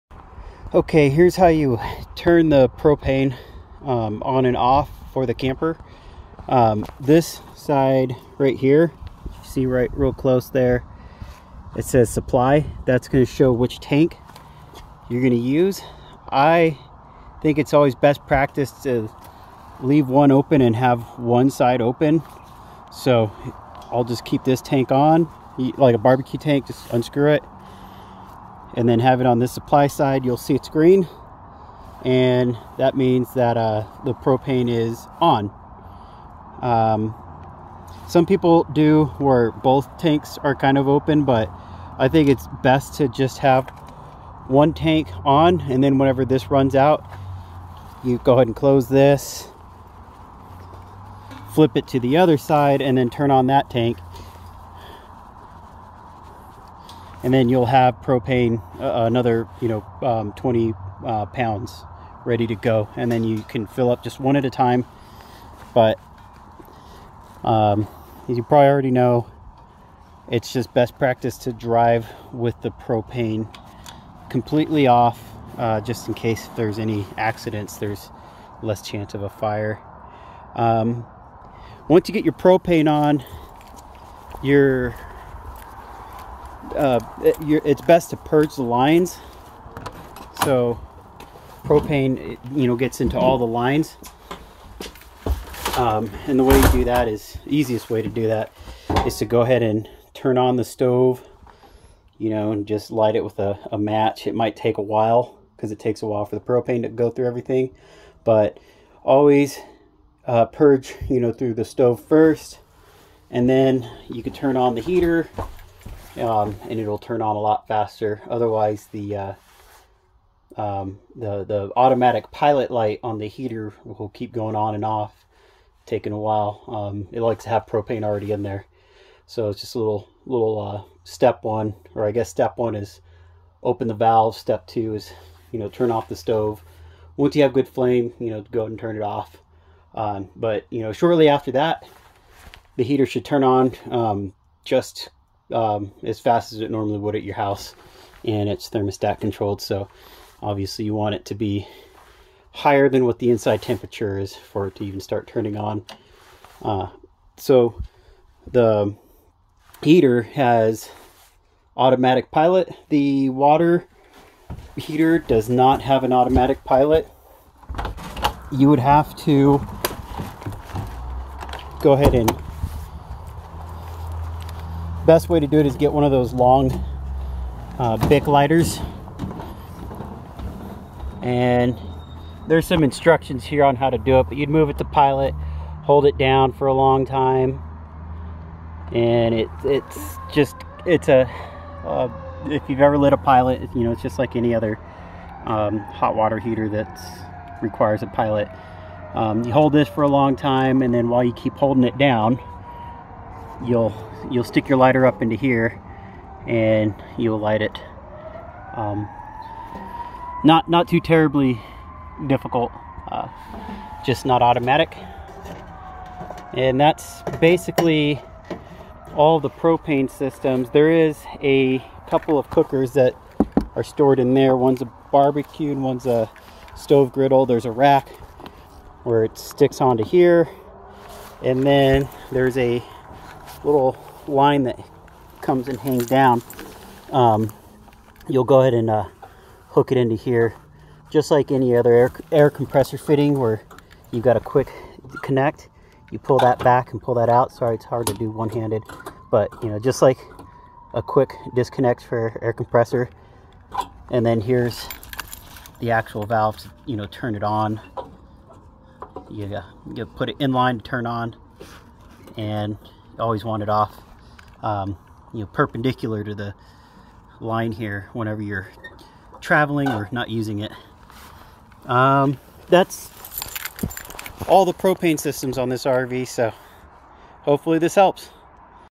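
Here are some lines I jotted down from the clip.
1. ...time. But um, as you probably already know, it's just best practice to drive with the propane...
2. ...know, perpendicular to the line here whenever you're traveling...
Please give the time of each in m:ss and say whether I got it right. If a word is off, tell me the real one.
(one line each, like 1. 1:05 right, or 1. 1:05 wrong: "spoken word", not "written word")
1. 1:04 right
2. 4:25 right.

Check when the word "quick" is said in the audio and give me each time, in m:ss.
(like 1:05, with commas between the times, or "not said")
4:04, 4:11.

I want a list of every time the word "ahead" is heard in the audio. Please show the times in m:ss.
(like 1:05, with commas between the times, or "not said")
0:48, 1:39, 2:18, 2:51, 3:58.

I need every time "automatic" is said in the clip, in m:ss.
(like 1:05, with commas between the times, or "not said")
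2:01, 2:41, 2:46, 3:34.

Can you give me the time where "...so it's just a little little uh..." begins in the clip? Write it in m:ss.
2:09.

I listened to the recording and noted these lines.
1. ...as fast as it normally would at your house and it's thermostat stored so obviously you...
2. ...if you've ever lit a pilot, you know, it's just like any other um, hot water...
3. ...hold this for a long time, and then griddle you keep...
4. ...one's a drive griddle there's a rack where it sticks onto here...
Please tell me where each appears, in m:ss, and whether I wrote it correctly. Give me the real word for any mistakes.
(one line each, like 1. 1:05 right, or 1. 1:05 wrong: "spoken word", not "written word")
1. 2:26 wrong: "controlled", not "stored"
2. 3:12 right
3. 3:19 wrong: "while", not "griddle"
4. 3:45 wrong: "stove", not "drive".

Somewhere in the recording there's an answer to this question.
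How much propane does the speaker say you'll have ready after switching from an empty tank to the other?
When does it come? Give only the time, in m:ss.
1:00.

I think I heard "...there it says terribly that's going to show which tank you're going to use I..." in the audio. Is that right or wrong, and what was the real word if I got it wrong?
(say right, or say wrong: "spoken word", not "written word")
wrong: "supply", not "terribly".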